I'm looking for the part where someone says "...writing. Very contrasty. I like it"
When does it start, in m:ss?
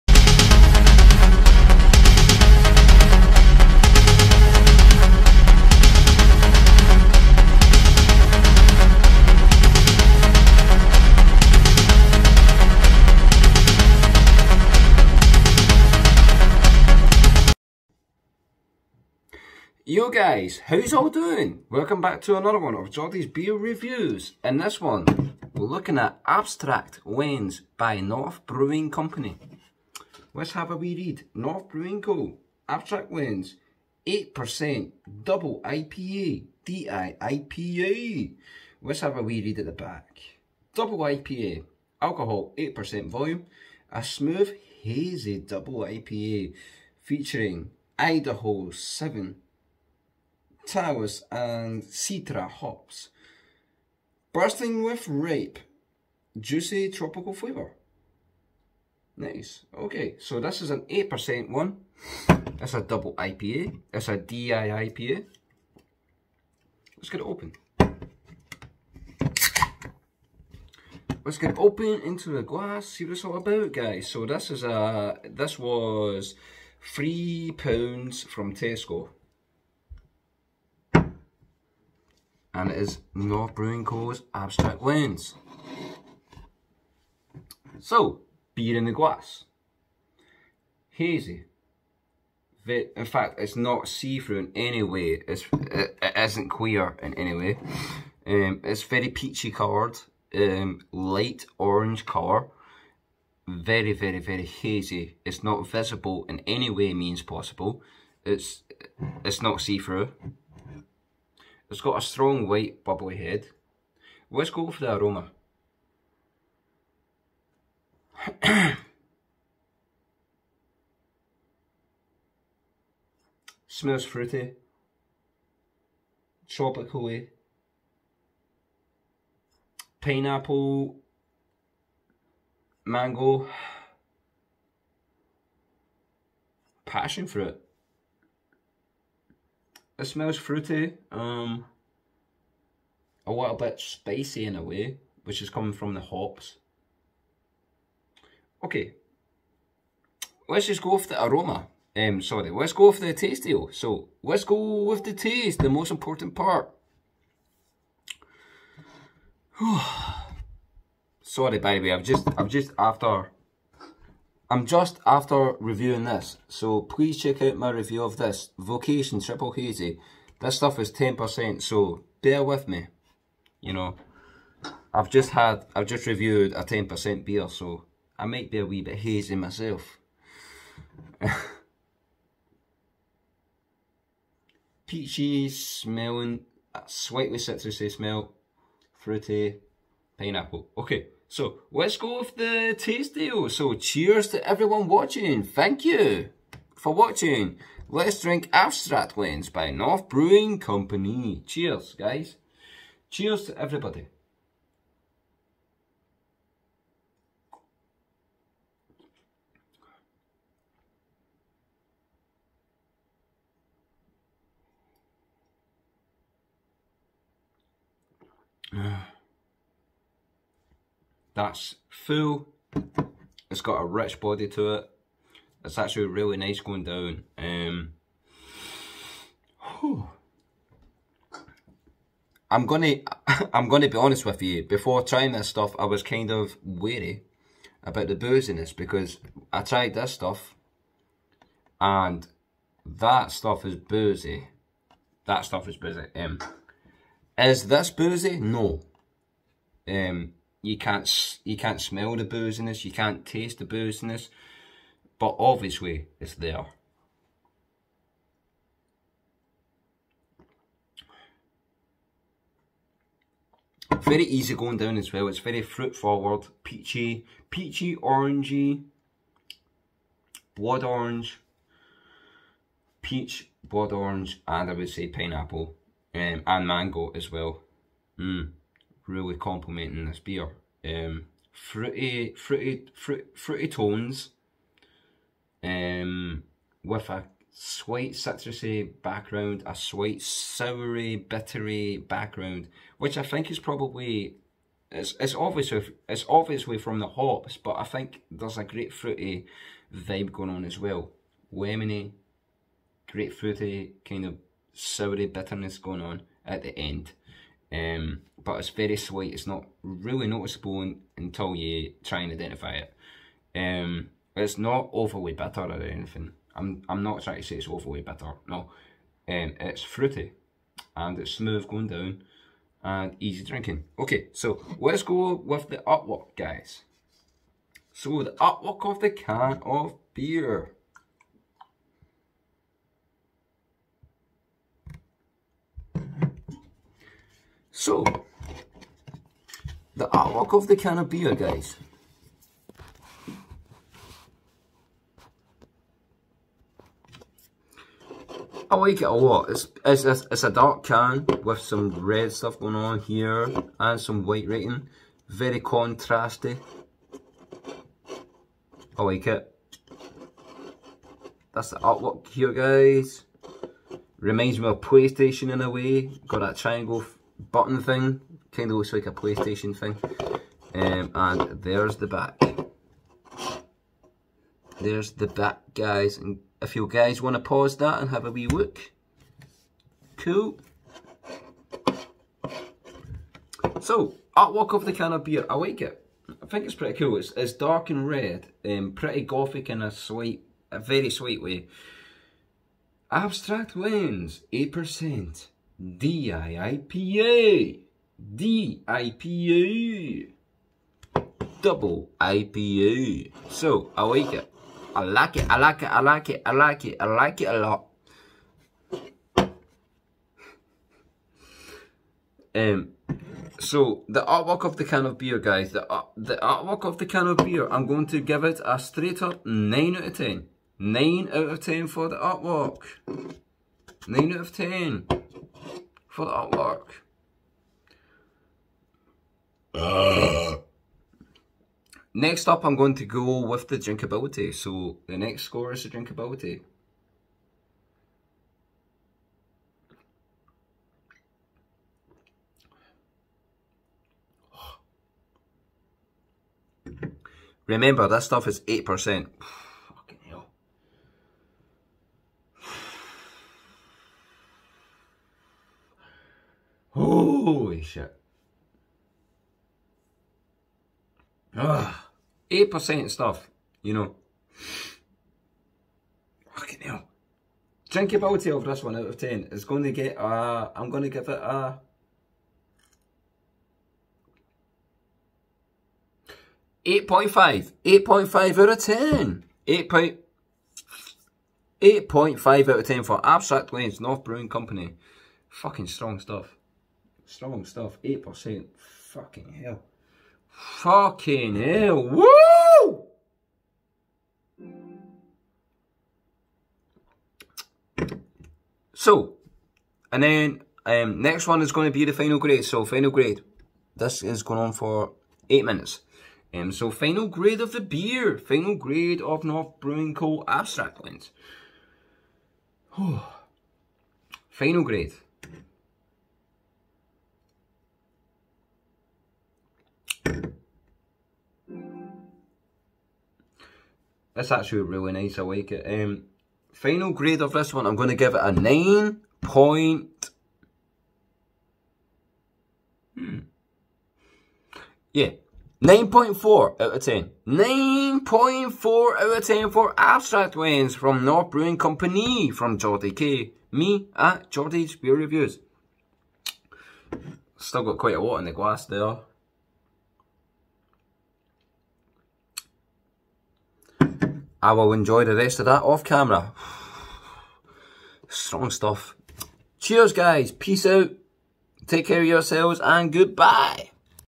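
5:54.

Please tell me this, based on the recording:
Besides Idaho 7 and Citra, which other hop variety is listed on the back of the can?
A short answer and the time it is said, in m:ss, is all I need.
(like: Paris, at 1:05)
Talus, at 0:50.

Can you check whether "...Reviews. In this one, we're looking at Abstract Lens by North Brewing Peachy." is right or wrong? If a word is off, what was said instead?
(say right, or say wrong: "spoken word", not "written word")
wrong: "Company", not "Peachy".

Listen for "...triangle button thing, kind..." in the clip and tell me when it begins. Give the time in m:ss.
6:06.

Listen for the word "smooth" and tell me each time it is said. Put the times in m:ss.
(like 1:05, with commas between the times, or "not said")
0:44, 5:21.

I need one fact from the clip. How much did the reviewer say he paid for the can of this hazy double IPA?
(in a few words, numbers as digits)
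3 pounds.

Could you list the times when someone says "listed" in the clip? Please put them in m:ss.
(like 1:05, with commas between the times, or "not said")
not said.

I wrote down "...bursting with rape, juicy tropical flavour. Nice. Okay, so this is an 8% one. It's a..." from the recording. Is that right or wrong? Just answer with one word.
right.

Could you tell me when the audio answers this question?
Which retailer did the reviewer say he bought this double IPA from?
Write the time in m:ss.
1:18.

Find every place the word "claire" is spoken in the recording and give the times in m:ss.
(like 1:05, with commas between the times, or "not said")
not said.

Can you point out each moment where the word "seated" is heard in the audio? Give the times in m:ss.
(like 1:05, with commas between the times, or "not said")
not said.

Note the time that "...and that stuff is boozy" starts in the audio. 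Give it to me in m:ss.
4:01.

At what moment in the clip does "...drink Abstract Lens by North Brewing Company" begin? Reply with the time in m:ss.
3:18.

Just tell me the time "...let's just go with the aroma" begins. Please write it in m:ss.
2:30.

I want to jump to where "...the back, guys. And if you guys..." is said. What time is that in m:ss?
6:15.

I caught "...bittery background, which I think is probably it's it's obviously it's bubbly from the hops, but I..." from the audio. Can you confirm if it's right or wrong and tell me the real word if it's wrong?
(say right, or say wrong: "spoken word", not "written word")
wrong: "obviously", not "bubbly".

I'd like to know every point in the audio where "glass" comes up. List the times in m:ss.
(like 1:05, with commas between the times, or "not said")
1:12, 1:28, 9:08.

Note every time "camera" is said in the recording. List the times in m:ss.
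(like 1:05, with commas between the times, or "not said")
9:16.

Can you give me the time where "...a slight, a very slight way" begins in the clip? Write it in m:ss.
6:29.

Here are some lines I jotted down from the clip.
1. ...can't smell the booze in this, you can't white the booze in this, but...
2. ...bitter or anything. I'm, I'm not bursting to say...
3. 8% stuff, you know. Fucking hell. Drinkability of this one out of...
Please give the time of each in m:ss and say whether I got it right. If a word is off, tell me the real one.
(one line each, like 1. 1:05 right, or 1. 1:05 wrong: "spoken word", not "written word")
1. 4:11 wrong: "taste", not "white"
2. 5:15 wrong: "trying", not "bursting"
3. 7:42 right.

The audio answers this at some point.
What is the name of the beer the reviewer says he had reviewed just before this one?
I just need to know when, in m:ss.
2:48.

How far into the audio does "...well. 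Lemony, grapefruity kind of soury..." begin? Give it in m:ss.
5:00.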